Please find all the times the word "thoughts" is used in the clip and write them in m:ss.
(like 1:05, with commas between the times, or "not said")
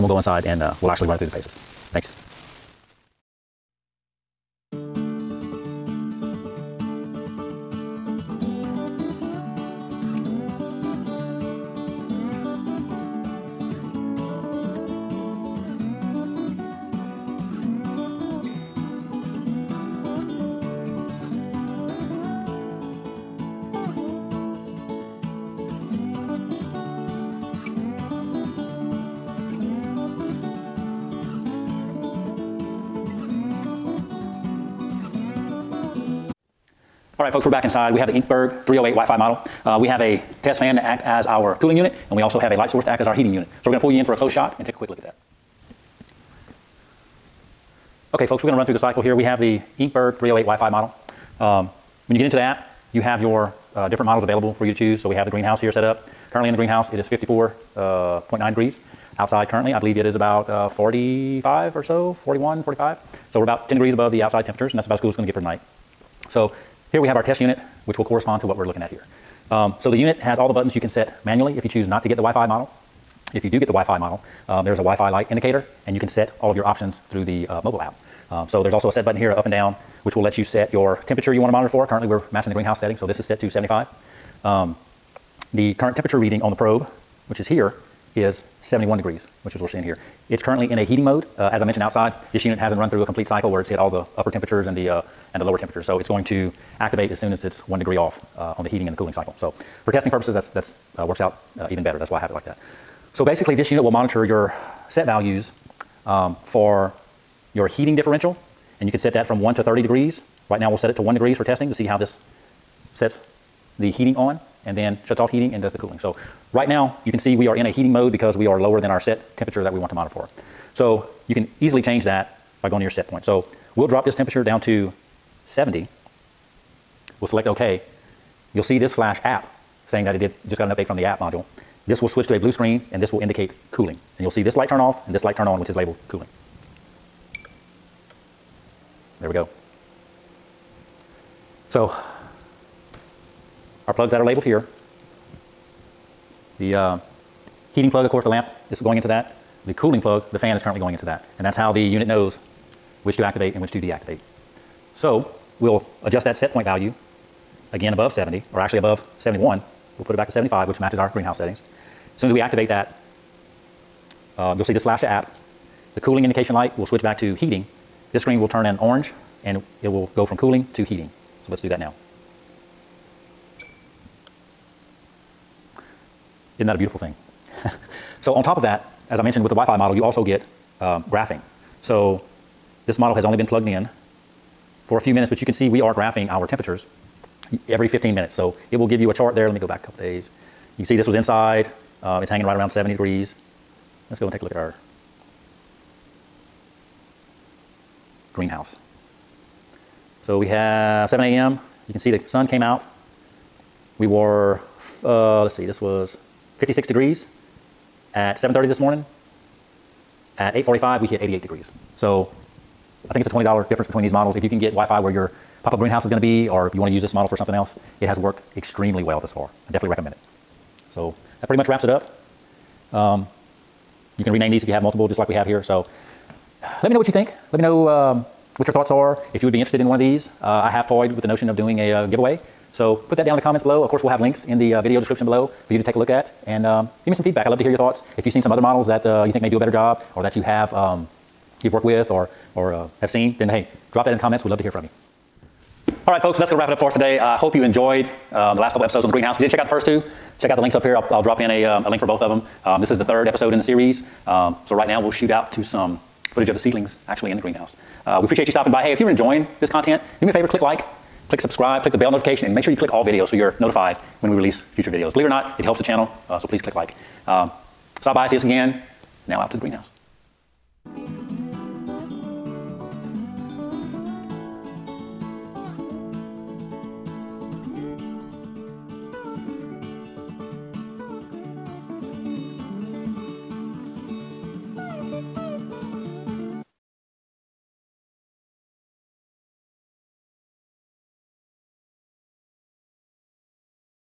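3:48, 3:57.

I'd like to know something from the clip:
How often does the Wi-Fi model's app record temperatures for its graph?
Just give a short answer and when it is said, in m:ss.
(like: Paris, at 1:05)
Every 15 minutes, at 3:07.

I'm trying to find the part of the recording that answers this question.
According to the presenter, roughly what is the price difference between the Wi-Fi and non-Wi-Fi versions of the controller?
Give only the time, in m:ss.
3:33.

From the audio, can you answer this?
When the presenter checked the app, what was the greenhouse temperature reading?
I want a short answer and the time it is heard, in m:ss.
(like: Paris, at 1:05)
54.9 degrees, at 0:57.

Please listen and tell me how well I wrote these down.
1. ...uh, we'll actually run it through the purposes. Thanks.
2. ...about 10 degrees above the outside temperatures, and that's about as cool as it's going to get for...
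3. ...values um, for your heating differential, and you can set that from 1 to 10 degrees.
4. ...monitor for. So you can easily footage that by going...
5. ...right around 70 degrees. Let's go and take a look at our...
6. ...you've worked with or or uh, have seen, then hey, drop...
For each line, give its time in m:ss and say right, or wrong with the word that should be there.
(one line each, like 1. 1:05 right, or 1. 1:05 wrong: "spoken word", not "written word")
1. 0:00 wrong: "paces", not "purposes"
2. 1:03 right
3. 1:45 wrong: "30", not "10"
4. 1:59 wrong: "change", not "footage"
5. 3:12 right
6. 4:01 right.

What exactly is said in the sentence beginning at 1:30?
It's currently in a heating mode.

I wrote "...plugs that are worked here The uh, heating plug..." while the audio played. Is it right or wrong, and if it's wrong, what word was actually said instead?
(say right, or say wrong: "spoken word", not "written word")
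wrong: "labeled", not "worked".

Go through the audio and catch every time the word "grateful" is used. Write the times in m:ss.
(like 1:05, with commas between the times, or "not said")
not said.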